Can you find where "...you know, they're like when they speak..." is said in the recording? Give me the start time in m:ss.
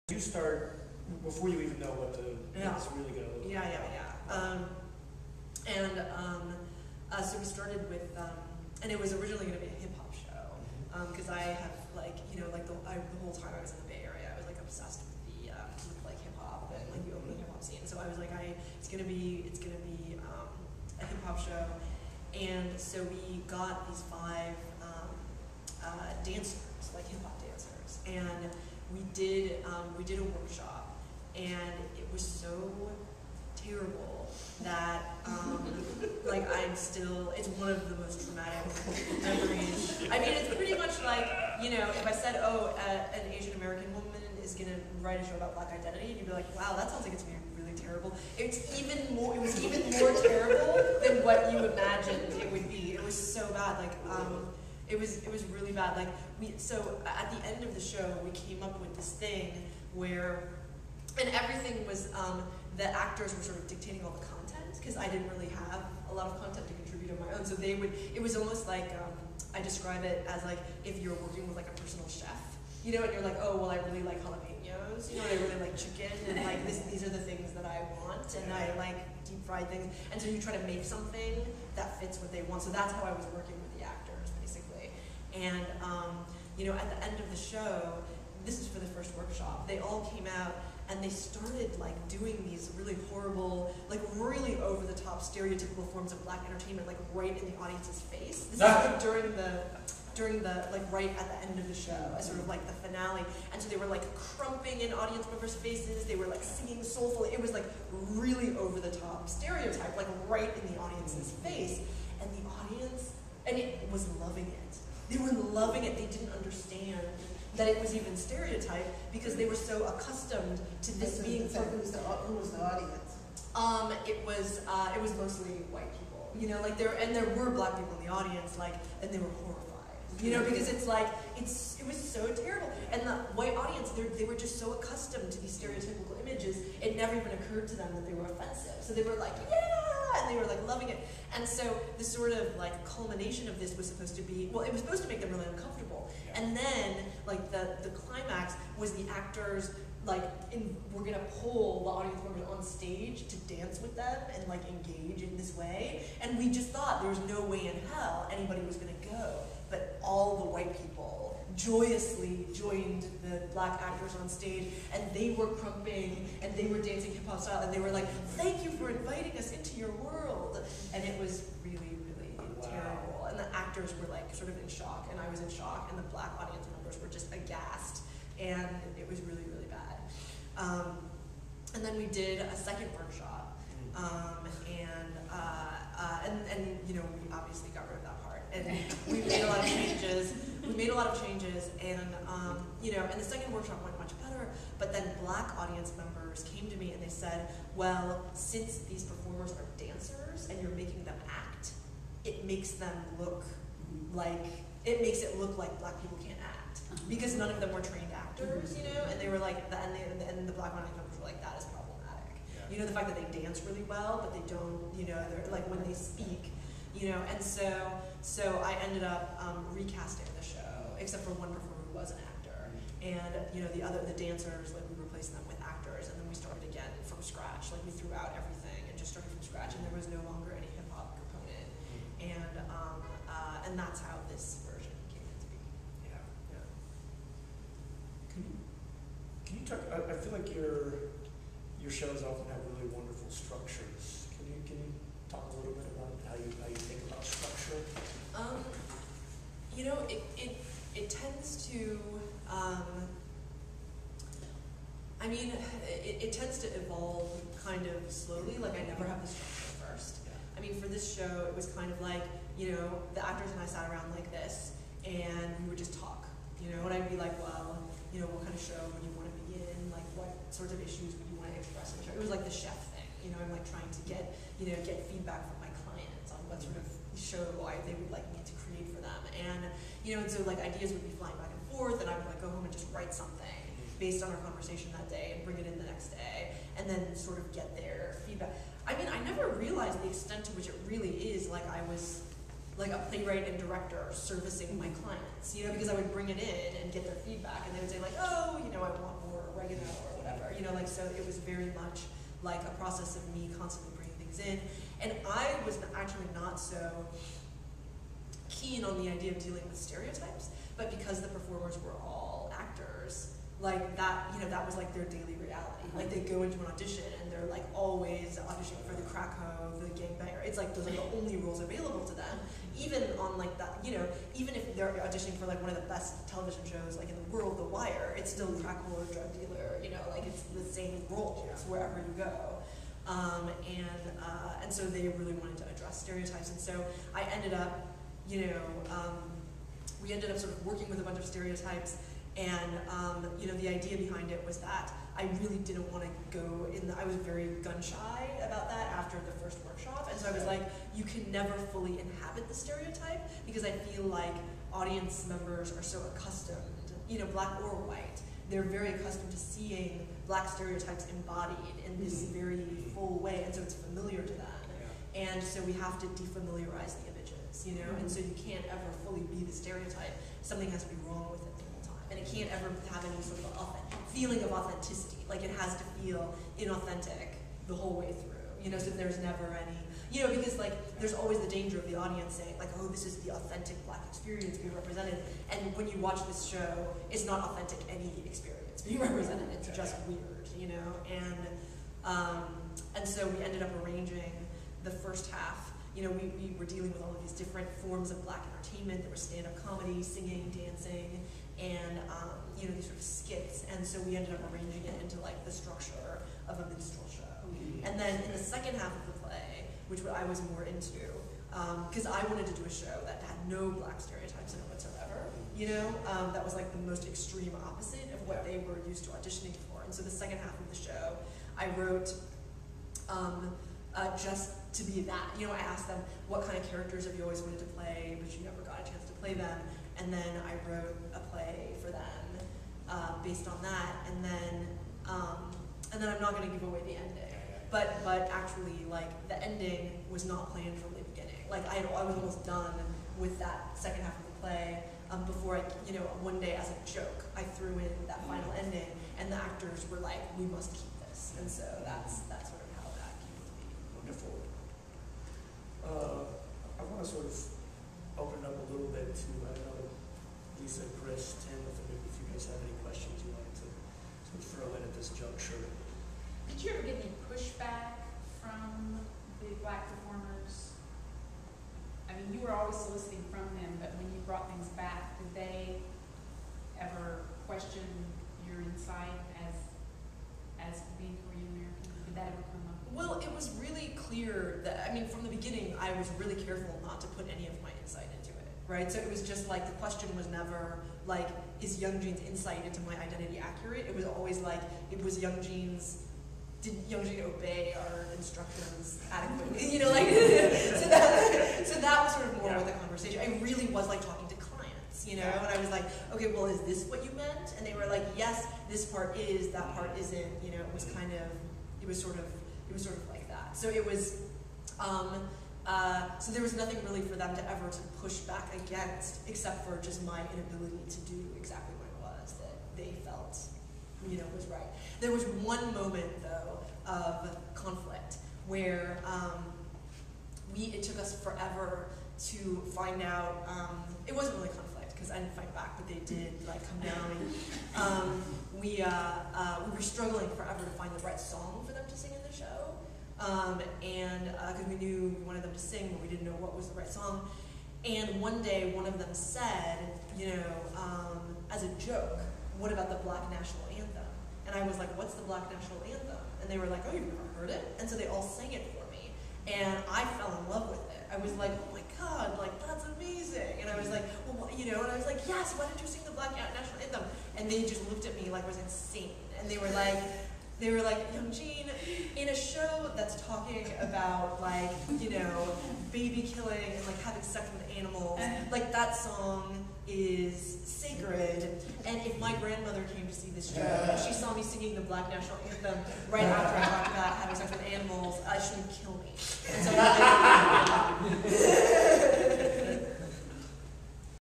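3:34.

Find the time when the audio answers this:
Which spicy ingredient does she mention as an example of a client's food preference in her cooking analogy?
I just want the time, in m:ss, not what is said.
1:14.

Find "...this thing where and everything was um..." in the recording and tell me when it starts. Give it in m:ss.
0:58.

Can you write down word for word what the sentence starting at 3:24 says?
like it makes it look like black people can't act uh-huh.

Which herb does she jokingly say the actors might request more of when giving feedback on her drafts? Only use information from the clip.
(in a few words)
oregano.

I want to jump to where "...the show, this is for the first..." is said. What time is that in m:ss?
1:27.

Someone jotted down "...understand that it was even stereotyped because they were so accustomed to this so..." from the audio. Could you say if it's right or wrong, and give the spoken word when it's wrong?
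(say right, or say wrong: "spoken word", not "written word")
right.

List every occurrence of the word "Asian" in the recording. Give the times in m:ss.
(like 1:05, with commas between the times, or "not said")
0:43.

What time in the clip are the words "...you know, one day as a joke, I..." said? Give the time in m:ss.
7:25.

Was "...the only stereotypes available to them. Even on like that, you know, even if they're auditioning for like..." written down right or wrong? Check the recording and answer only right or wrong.
wrong.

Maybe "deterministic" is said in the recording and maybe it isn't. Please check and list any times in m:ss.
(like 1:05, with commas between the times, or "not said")
not said.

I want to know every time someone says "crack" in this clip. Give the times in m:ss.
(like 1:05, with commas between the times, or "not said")
5:19, 5:28.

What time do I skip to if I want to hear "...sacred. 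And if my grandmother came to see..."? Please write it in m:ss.
9:40.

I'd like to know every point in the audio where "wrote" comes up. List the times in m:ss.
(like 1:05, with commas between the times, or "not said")
7:01, 7:10.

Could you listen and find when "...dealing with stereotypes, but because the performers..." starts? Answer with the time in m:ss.
5:09.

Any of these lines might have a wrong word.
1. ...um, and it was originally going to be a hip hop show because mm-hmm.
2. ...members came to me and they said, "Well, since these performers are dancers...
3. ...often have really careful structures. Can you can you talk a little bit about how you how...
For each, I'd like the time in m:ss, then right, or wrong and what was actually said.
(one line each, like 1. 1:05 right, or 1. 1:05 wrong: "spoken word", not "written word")
1. 0:08 right
2. 3:15 right
3. 4:02 wrong: "wonderful", not "careful".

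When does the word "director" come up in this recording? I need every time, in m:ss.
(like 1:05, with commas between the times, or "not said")
4:53.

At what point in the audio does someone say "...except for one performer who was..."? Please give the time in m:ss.
3:41.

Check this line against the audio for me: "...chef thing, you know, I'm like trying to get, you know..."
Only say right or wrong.
right.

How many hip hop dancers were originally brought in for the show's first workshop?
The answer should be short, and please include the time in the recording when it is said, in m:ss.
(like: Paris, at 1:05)
5, at 0:24.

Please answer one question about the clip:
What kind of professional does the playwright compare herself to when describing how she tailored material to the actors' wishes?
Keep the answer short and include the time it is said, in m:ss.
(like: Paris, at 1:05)
personal chef, at 1:11.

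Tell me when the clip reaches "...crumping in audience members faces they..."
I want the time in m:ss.
1:44.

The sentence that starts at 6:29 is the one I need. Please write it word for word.
It's just weird, you know, and.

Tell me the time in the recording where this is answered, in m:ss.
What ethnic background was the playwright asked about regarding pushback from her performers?
8:01.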